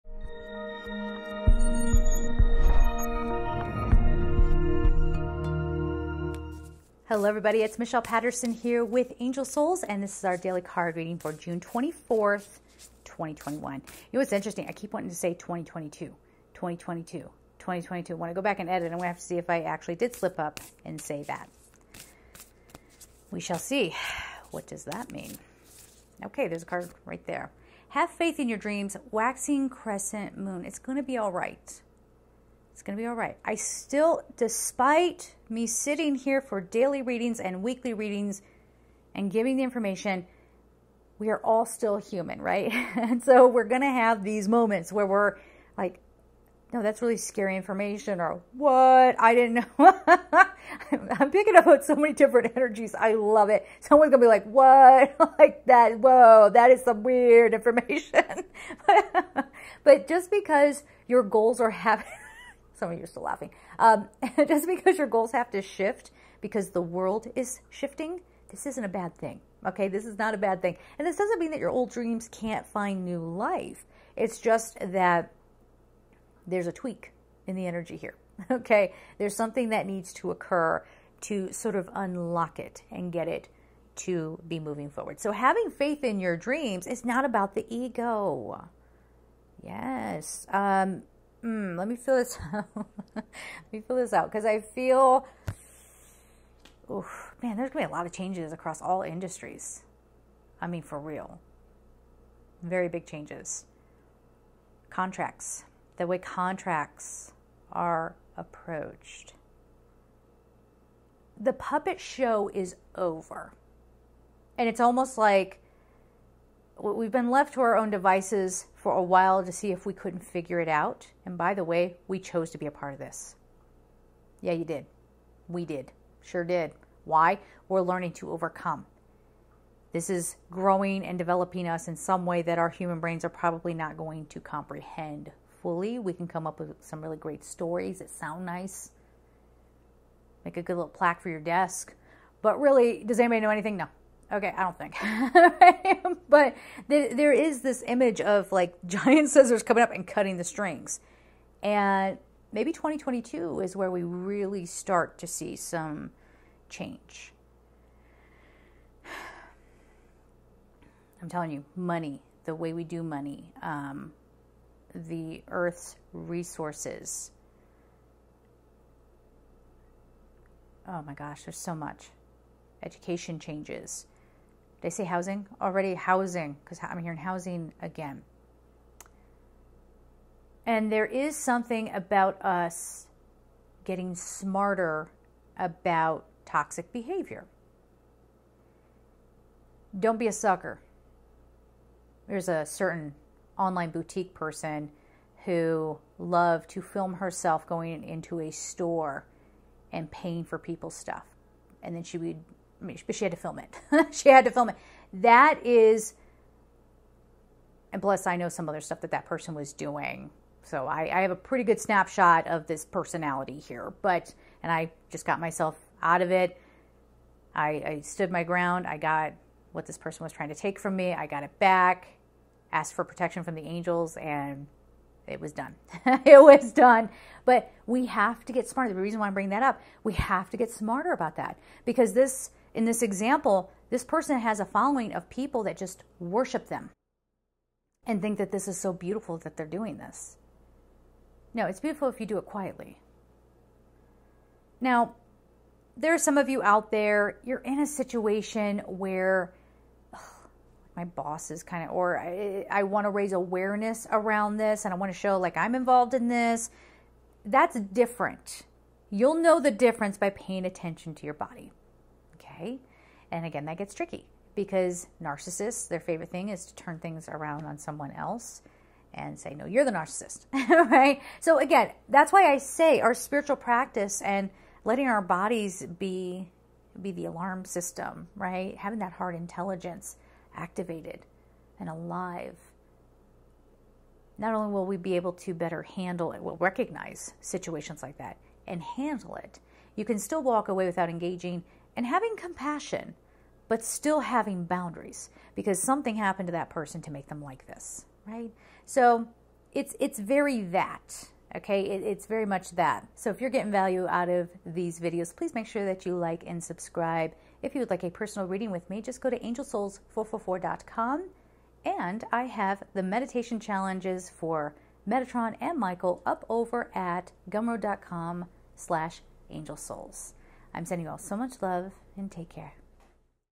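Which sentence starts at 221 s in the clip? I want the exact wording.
I got it back, asked for protection from the angels, and it was done.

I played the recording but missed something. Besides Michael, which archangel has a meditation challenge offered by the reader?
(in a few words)
Metatron.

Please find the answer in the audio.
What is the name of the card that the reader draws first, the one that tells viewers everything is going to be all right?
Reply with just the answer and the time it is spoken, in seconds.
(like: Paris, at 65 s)
Have faith in your dreams, at 27 s.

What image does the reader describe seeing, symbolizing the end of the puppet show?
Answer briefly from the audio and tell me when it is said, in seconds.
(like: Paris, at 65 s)
Giant scissors, at 148 s.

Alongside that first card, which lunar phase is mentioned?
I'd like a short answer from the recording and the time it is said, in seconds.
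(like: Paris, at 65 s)
Waxing crescent moon, at 29 s.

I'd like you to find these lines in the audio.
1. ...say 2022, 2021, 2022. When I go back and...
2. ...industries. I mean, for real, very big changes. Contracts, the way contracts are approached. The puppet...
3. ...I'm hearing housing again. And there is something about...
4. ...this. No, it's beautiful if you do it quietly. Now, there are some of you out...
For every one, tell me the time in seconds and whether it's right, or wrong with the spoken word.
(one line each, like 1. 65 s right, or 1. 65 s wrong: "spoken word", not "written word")
1. 15 s wrong: "2022", not "2021"
2. 99 s right
3. 176 s right
4. 239 s right.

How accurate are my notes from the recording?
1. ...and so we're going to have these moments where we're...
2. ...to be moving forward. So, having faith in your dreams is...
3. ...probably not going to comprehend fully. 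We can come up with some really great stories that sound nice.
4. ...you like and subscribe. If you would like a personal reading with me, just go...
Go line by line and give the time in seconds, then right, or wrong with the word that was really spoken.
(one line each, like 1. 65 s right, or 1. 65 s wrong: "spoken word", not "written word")
1. 42 s right
2. 83 s right
3. 133 s right
4. 306 s right.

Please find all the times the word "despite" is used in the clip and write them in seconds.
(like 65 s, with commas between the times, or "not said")
34 s.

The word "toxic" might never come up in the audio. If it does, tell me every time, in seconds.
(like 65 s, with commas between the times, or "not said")
186 s.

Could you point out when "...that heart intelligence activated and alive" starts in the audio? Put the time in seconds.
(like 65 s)
278 s.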